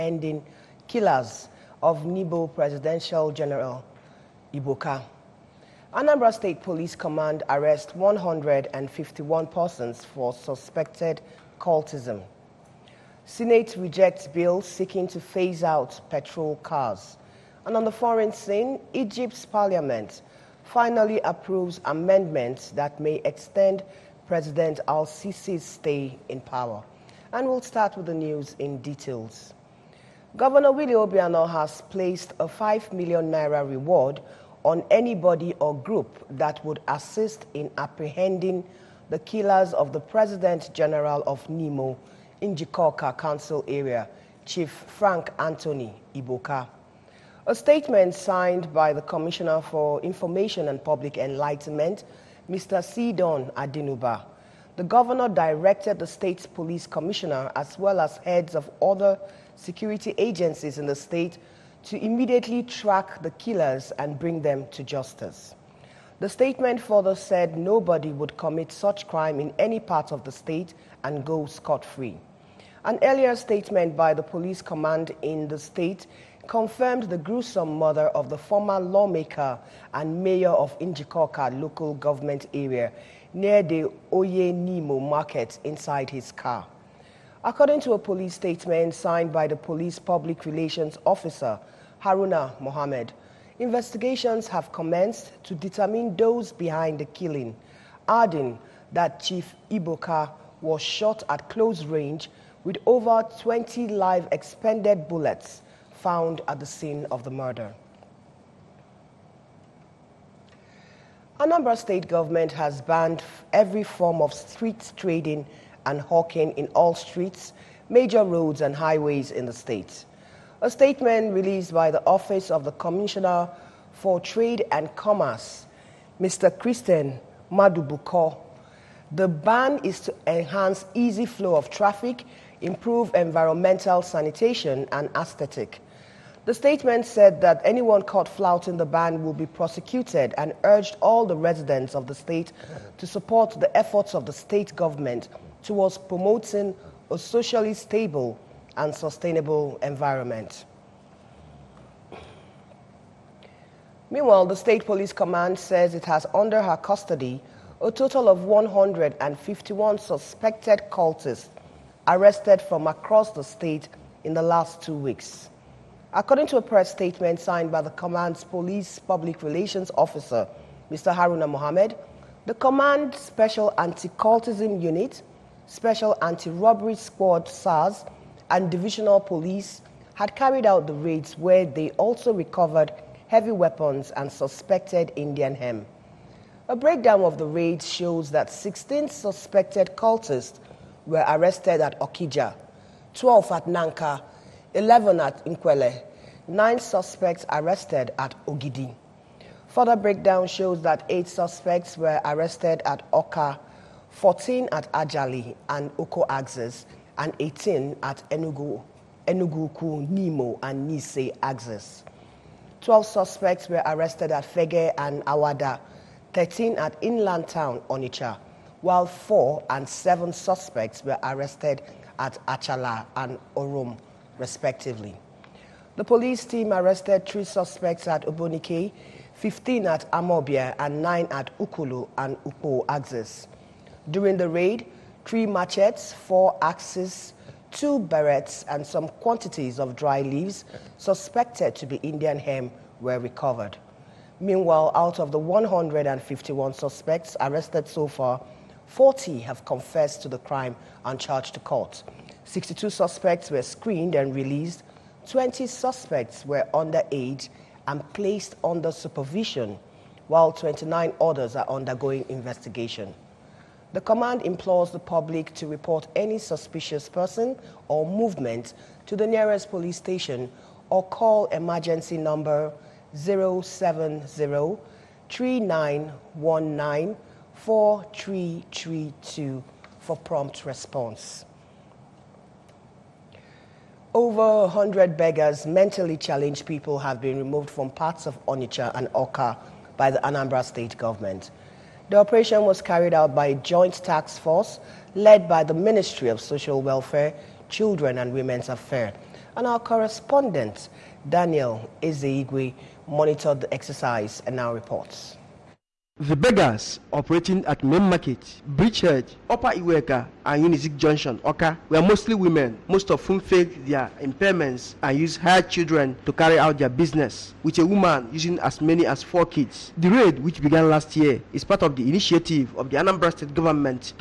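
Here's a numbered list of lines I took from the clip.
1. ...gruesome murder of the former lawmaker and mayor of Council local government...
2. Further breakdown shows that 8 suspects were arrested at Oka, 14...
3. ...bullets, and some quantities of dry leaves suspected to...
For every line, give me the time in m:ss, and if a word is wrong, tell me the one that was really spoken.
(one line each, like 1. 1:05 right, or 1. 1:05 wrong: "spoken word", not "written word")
1. 1:17 wrong: "Njikoka", not "Council"
2. 3:19 right
3. 3:57 wrong: "berets", not "bullets".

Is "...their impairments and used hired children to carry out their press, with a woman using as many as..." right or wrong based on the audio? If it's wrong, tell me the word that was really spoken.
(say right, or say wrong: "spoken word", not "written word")
wrong: "business", not "press".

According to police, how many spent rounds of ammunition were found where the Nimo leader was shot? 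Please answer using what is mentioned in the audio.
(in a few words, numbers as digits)
over 20.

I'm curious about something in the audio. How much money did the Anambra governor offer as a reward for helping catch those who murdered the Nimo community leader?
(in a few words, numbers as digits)
5 million naira.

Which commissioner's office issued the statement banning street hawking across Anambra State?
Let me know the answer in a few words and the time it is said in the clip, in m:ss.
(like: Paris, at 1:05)
Trade and Commerce, at 2:04.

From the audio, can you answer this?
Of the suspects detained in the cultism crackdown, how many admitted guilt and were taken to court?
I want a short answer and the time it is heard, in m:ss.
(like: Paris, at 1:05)
40, at 4:08.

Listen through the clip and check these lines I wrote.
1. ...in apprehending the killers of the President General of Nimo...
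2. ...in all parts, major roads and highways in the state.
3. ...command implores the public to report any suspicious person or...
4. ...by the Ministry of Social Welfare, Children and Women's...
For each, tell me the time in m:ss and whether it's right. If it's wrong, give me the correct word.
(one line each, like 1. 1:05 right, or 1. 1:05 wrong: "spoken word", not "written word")
1. 0:37 right
2. 1:56 wrong: "streets", not "parts"
3. 4:24 right
4. 4:55 right.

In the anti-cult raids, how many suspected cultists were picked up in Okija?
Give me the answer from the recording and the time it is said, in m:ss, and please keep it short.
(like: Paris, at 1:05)
16, at 3:08.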